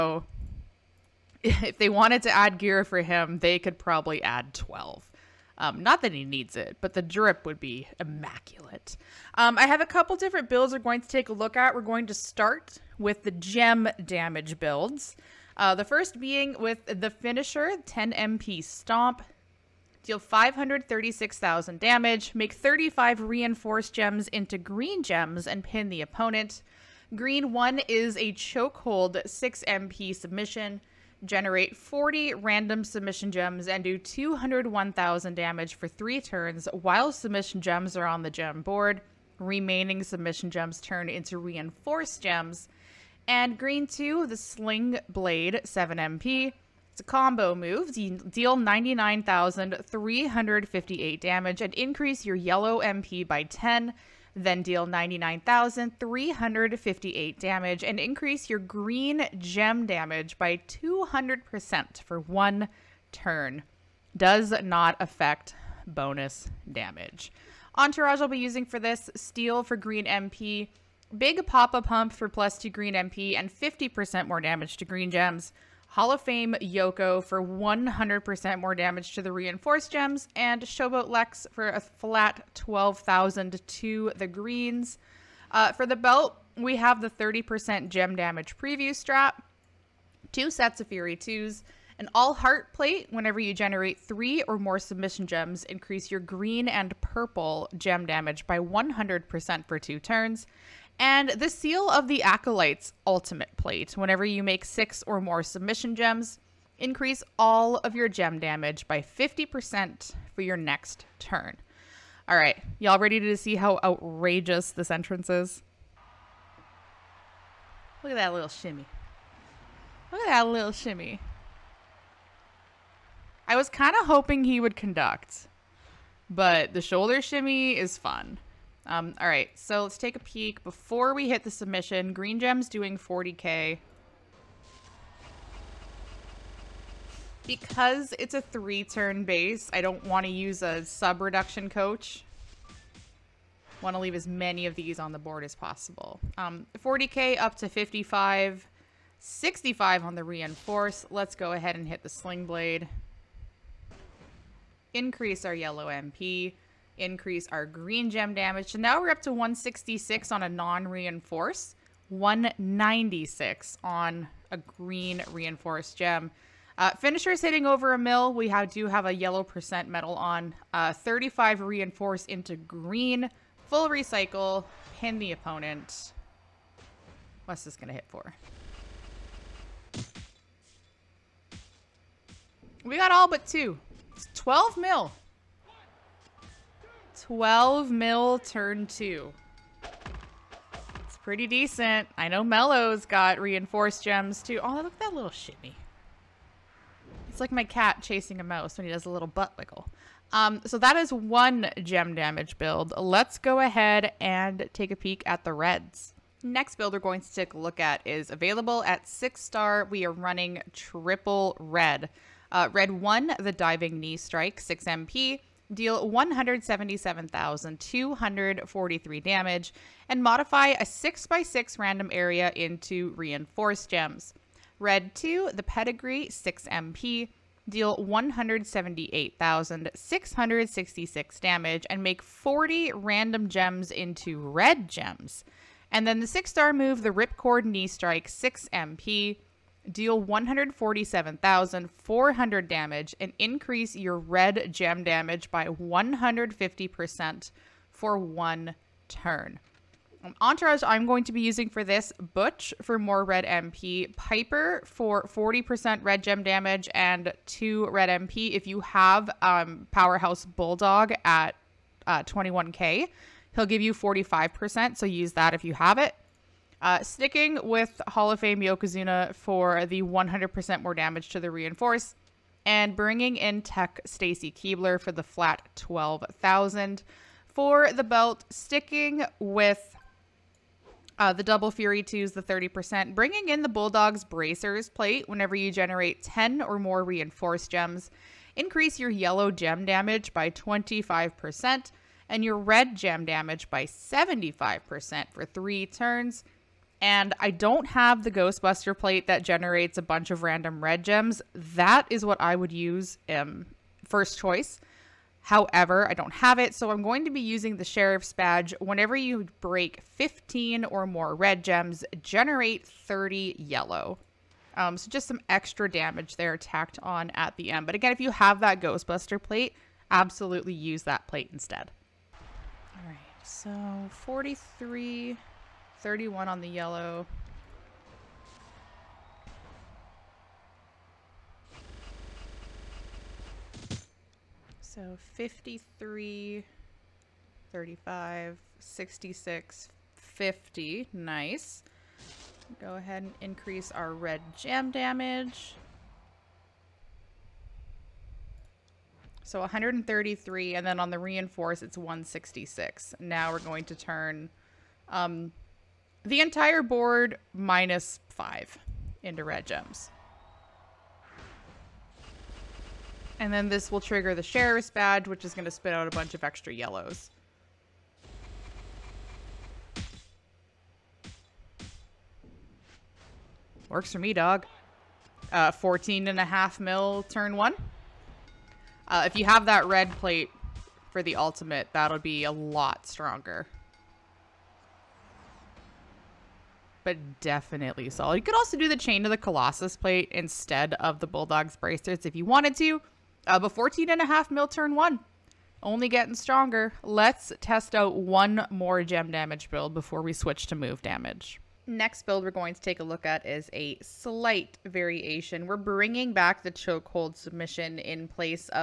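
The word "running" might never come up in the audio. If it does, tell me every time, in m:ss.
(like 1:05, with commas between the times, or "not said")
3:30.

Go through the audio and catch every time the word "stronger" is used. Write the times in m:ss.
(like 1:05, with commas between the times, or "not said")
6:23, 6:36.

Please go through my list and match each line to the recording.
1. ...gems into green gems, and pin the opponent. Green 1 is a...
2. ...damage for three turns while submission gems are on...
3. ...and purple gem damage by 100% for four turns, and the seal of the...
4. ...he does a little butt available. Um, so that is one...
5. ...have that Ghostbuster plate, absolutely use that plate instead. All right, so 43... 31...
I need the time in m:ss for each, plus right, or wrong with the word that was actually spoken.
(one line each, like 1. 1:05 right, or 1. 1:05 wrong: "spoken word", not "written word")
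1. 0:23 right
2. 0:35 right
3. 1:36 wrong: "two", not "four"
4. 3:18 wrong: "wiggle", not "available"
5. 5:18 right.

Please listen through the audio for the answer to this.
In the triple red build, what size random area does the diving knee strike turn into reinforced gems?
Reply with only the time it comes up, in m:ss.
3:40.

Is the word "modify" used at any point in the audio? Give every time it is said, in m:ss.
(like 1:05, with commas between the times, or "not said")
3:40.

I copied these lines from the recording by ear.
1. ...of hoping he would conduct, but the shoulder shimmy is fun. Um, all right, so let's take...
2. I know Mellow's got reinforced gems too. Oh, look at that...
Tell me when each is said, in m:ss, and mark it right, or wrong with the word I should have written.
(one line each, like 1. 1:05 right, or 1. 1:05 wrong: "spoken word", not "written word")
1. 2:03 right
2. 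3:12 right.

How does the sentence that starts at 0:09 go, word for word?
Um, I have a couple different builds we're going to take a look at.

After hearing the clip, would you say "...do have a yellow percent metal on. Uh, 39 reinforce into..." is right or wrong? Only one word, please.
wrong.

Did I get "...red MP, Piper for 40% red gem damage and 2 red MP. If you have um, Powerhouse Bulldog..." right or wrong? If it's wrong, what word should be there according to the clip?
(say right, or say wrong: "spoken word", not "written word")
right.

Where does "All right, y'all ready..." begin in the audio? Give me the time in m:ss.
1:52.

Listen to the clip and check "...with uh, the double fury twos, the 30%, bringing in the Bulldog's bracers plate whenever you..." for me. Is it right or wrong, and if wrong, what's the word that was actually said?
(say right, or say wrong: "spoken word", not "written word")
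right.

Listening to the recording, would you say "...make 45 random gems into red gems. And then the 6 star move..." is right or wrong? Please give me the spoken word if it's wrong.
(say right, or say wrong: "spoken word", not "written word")
wrong: "40", not "45".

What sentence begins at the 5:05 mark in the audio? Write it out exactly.
However, I don't have it, so I'm going to be using the Sheriff's Badge.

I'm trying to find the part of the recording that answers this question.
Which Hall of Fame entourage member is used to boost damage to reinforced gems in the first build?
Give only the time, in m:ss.
1:15.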